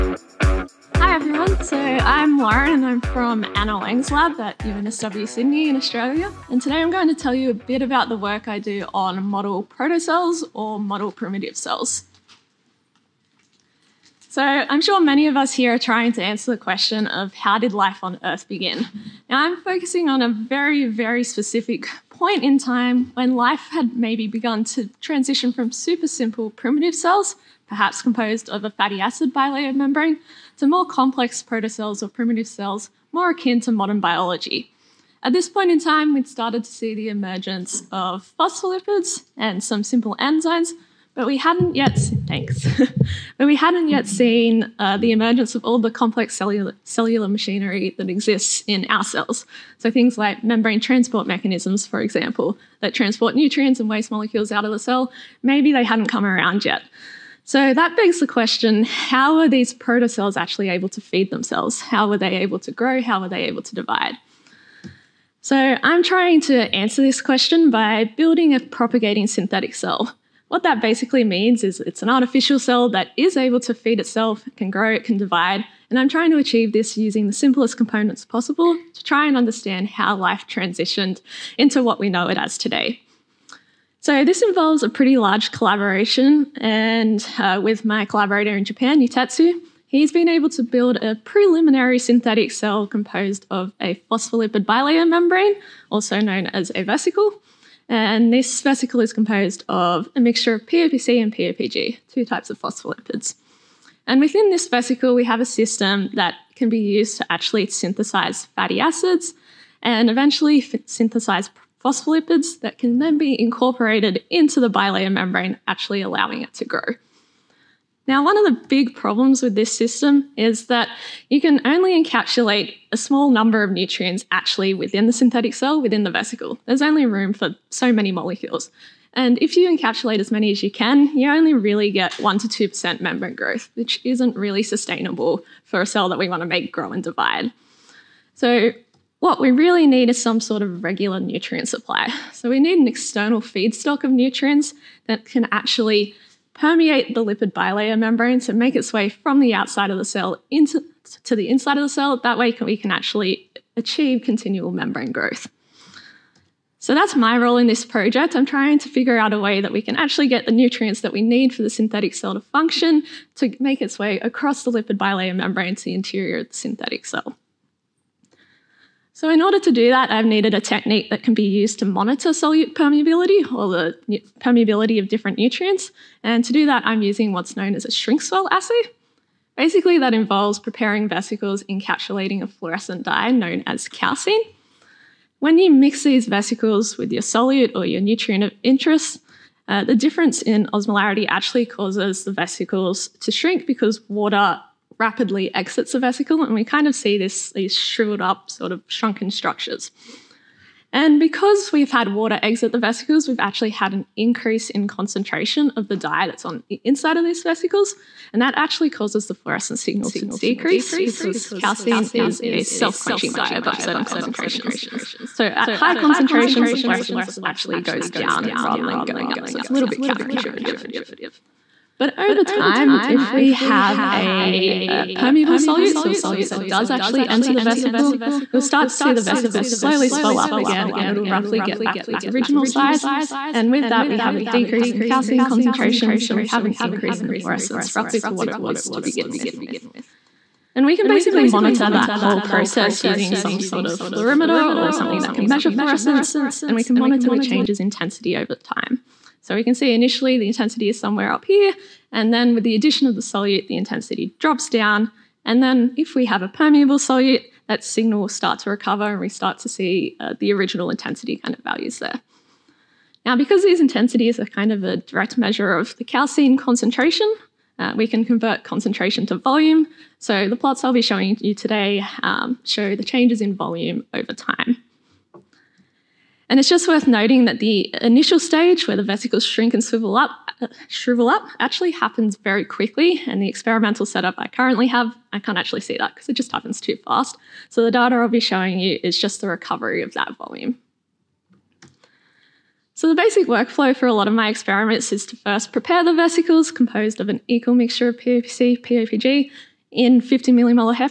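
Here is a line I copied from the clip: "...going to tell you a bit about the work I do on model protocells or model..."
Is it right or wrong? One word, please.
right.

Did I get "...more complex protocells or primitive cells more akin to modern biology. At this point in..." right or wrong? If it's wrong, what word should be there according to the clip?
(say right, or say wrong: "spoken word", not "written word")
right.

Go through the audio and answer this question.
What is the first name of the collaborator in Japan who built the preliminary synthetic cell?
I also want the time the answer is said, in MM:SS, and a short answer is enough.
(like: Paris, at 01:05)
Yutatsu, at 01:29.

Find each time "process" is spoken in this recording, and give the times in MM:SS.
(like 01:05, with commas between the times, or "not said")
04:02.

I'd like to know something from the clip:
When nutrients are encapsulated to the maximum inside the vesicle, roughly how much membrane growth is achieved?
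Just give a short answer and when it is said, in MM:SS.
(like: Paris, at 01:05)
1% to 2%, at 02:12.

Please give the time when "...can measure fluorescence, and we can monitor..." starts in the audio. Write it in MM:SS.
04:05.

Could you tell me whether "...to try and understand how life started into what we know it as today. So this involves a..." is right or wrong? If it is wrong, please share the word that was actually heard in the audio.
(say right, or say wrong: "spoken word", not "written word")
wrong: "transitioned", not "started".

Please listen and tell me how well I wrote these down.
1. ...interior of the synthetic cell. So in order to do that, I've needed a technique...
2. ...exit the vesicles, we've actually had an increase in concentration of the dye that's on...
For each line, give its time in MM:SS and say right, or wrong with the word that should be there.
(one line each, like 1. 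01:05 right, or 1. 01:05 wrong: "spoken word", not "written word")
1. 02:45 right
2. 03:22 right.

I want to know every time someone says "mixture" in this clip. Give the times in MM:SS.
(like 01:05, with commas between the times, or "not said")
01:40, 04:57.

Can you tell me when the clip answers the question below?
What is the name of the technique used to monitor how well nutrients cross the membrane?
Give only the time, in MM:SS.
02:57.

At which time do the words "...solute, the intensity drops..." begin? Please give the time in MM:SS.
04:13.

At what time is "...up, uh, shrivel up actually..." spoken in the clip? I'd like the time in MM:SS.
04:40.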